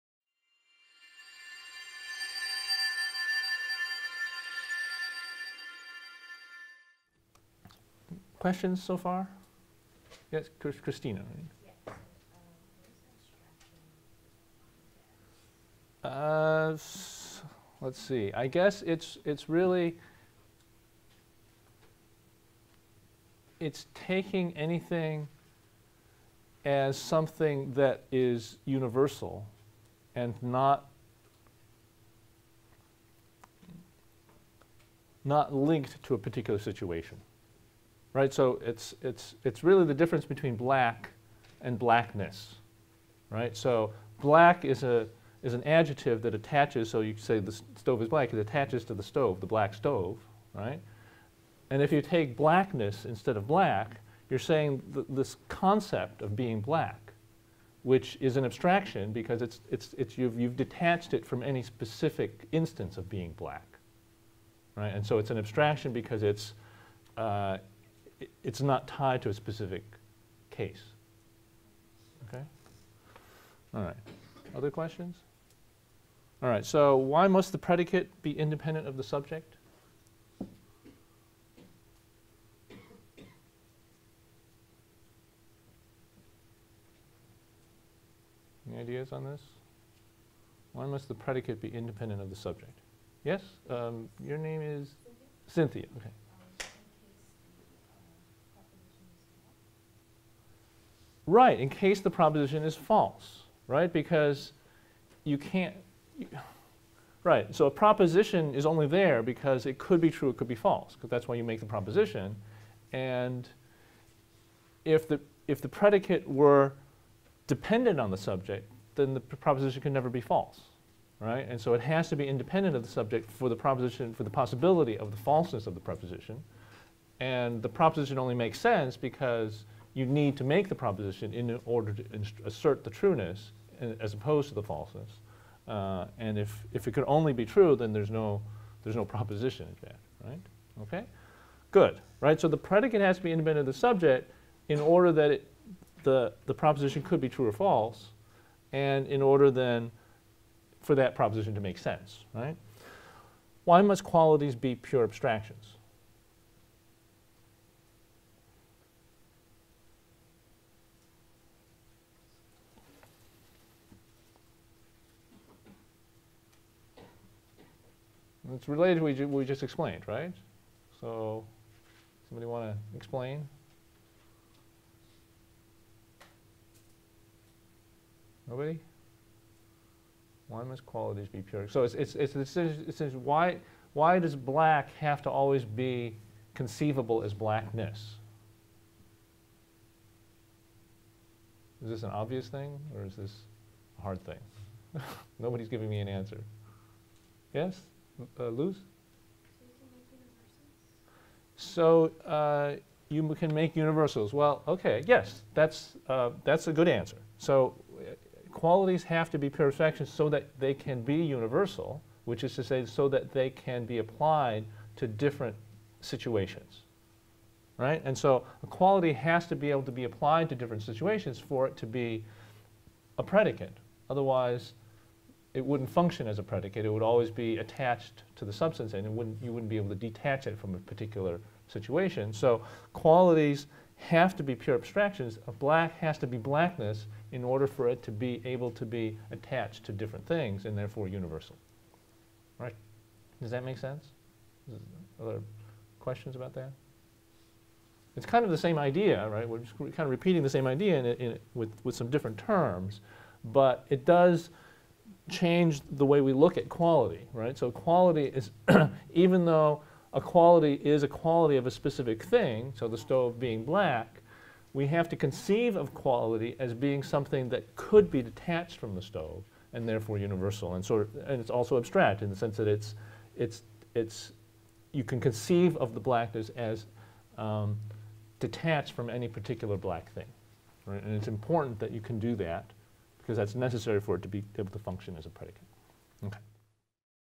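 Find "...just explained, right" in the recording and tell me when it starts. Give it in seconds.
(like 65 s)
169 s.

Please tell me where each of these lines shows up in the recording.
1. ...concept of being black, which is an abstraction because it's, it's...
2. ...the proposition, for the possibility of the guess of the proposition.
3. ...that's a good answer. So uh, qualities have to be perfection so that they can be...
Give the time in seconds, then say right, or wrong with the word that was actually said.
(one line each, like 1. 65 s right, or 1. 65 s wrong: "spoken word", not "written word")
1. 55 s right
2. 123 s wrong: "falseness", not "guess"
3. 206 s right.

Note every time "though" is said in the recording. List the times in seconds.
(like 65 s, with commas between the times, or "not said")
259 s.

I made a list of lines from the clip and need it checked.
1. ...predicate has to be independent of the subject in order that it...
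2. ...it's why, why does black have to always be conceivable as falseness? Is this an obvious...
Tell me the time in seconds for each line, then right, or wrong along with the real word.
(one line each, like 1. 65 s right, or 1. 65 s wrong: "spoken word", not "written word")
1. 142 s right
2. 183 s wrong: "blackness", not "falseness".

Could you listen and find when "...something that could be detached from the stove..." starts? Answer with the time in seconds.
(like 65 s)
267 s.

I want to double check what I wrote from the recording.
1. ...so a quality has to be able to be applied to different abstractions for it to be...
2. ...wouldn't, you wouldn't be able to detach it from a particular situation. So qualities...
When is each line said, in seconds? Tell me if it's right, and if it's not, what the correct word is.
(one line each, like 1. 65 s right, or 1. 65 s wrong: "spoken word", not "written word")
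1. 218 s wrong: "situations", not "abstractions"
2. 229 s right.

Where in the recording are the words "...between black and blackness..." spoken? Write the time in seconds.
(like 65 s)
40 s.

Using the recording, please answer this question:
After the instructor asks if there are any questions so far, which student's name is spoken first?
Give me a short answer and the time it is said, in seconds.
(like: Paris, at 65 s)
Christina, at 10 s.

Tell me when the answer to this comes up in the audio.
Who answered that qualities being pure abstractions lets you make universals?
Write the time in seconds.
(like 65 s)
198 s.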